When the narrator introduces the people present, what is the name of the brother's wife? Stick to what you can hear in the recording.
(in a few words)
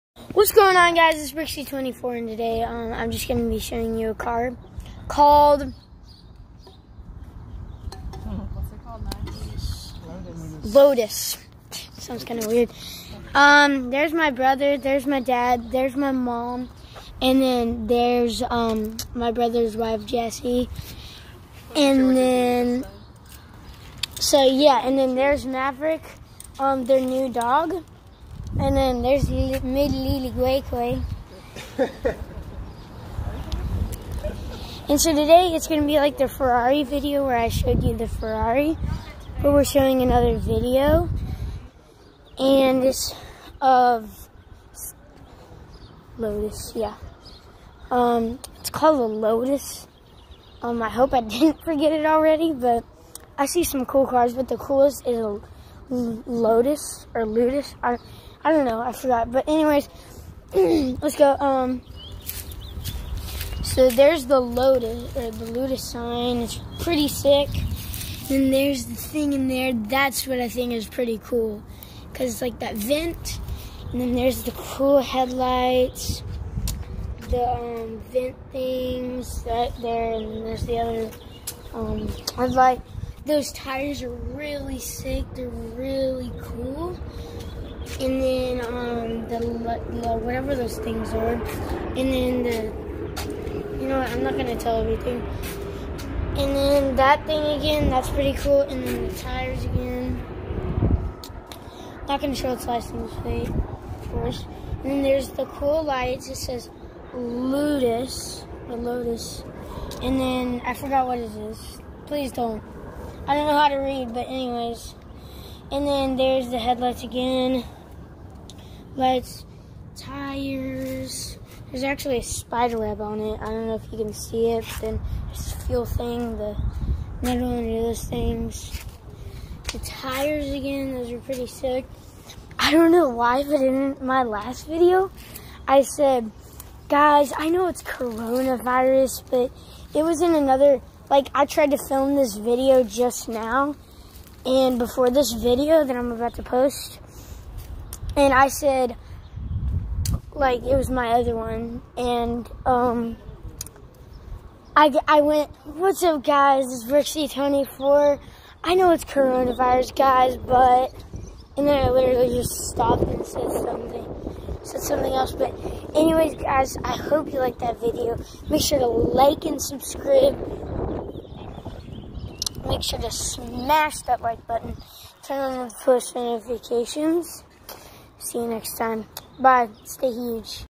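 Jessie.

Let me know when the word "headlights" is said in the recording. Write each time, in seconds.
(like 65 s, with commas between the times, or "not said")
75 s, 82 s, 116 s.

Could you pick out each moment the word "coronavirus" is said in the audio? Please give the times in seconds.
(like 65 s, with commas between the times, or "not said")
137 s, 159 s.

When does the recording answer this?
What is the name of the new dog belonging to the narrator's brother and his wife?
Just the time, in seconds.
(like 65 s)
25 s.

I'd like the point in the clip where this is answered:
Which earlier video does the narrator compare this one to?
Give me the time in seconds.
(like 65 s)
36 s.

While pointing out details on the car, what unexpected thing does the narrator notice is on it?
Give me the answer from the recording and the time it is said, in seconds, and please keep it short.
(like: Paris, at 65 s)
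A spider web, at 122 s.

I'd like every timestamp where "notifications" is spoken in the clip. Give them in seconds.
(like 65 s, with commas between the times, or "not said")
176 s.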